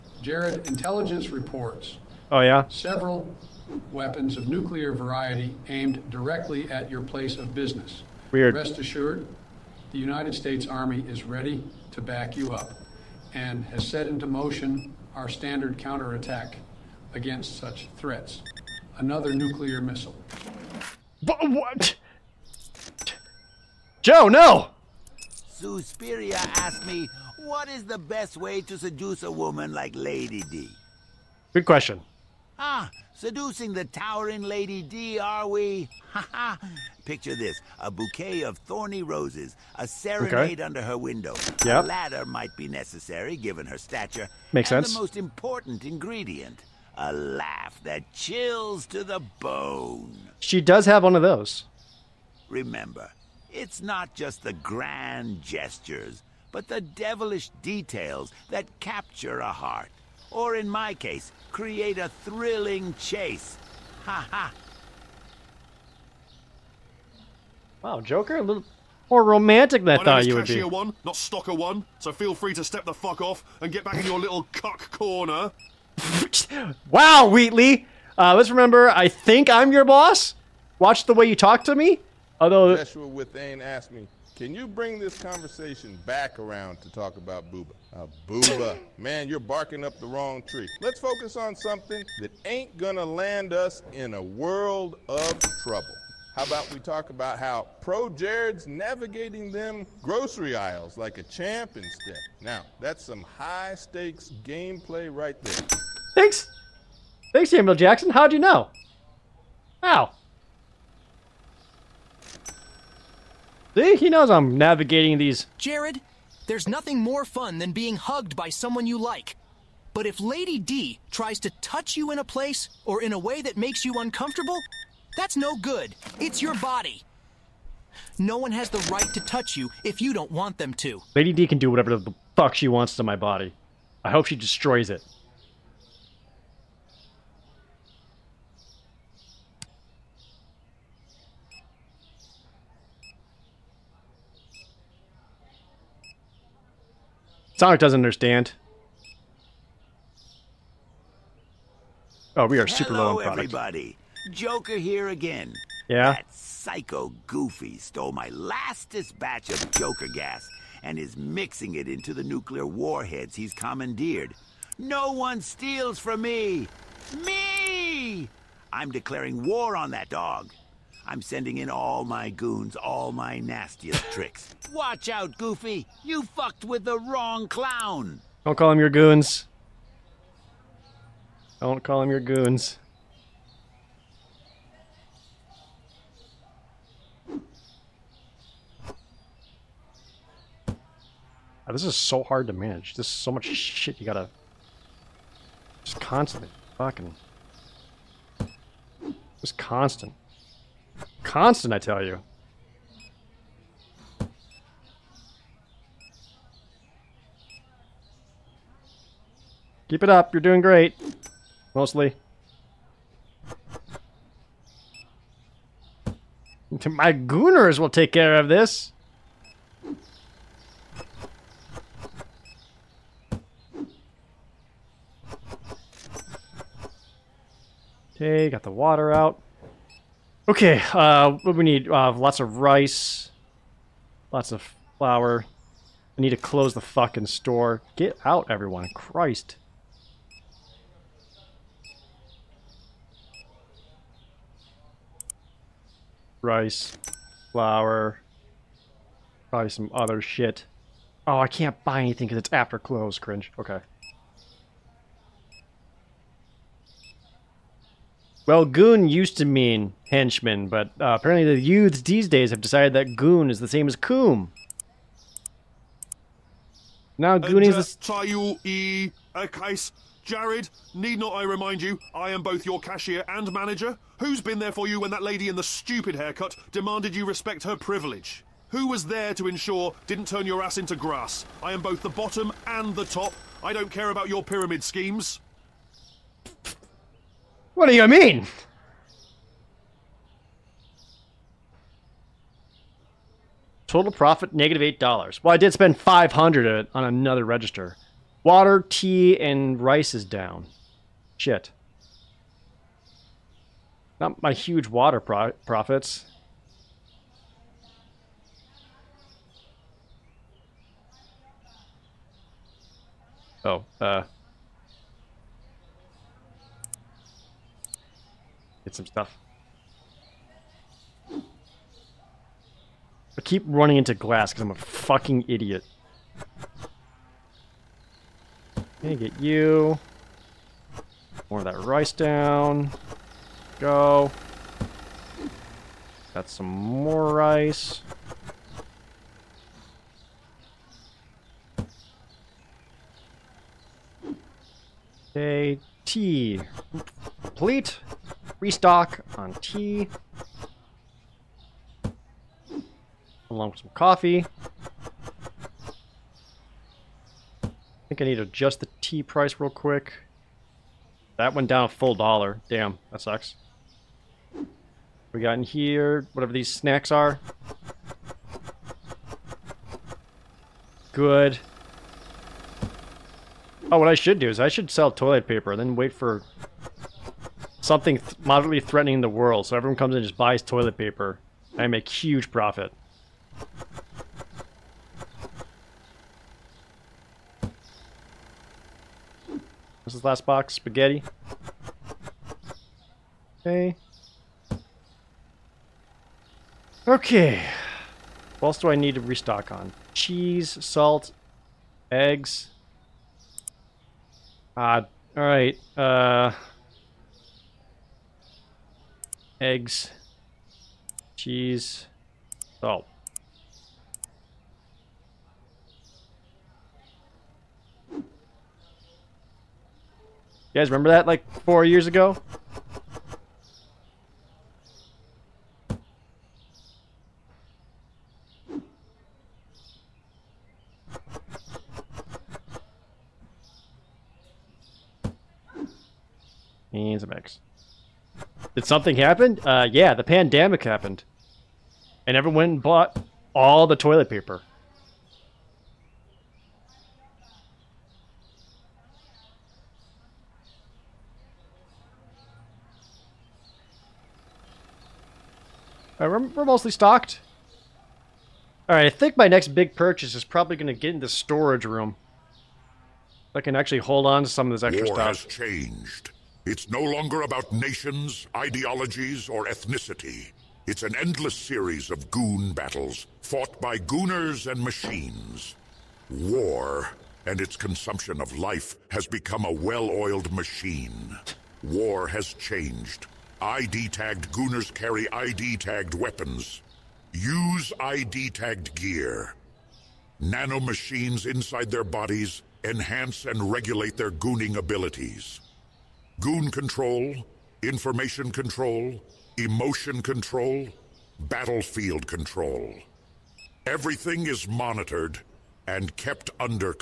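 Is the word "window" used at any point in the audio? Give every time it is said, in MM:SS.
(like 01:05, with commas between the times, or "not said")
00:40.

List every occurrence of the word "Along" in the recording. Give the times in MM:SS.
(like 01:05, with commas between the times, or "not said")
05:53.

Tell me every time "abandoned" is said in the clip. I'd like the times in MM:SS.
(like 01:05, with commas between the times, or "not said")
not said.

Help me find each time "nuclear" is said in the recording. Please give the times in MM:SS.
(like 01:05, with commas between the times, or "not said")
00:04, 00:19, 02:42.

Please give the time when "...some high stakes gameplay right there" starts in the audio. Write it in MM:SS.
01:43.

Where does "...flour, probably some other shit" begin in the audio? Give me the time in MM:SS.
04:07.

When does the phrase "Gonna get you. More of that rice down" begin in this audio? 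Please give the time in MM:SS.
05:29.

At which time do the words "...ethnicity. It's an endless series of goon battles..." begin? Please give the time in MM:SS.
07:49.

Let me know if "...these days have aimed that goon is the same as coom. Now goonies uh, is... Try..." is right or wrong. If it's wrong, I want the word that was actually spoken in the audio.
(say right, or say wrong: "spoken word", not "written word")
wrong: "decided", not "aimed".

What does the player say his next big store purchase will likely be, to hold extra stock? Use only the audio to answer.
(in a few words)
Storage room.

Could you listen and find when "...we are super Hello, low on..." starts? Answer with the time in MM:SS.
02:32.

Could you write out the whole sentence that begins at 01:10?
one, not stalker one, so feel free to step the fuck off and get back in your little cock corner.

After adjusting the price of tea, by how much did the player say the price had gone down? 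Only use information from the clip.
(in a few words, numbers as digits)
1 dollar.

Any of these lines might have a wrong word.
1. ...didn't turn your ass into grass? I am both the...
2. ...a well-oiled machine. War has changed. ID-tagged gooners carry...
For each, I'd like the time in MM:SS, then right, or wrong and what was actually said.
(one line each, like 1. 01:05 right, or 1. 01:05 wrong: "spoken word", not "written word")
1. 04:40 right
2. 07:59 right.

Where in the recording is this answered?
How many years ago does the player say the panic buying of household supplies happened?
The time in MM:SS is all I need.
07:01.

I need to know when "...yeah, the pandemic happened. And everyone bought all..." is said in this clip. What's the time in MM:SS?
07:19.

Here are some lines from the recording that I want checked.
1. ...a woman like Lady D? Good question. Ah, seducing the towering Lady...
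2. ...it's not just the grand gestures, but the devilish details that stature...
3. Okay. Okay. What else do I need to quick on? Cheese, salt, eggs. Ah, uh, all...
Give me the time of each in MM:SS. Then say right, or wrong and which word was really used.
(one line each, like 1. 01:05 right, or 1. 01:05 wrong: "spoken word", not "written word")
1. 00:29 right
2. 00:53 wrong: "capture", not "stature"
3. 06:33 wrong: "restock", not "quick".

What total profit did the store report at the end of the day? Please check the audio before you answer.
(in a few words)
-8 dollars.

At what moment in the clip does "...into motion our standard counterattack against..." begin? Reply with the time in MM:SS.
00:14.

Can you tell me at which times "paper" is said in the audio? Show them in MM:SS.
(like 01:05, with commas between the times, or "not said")
06:15, 06:20, 07:24.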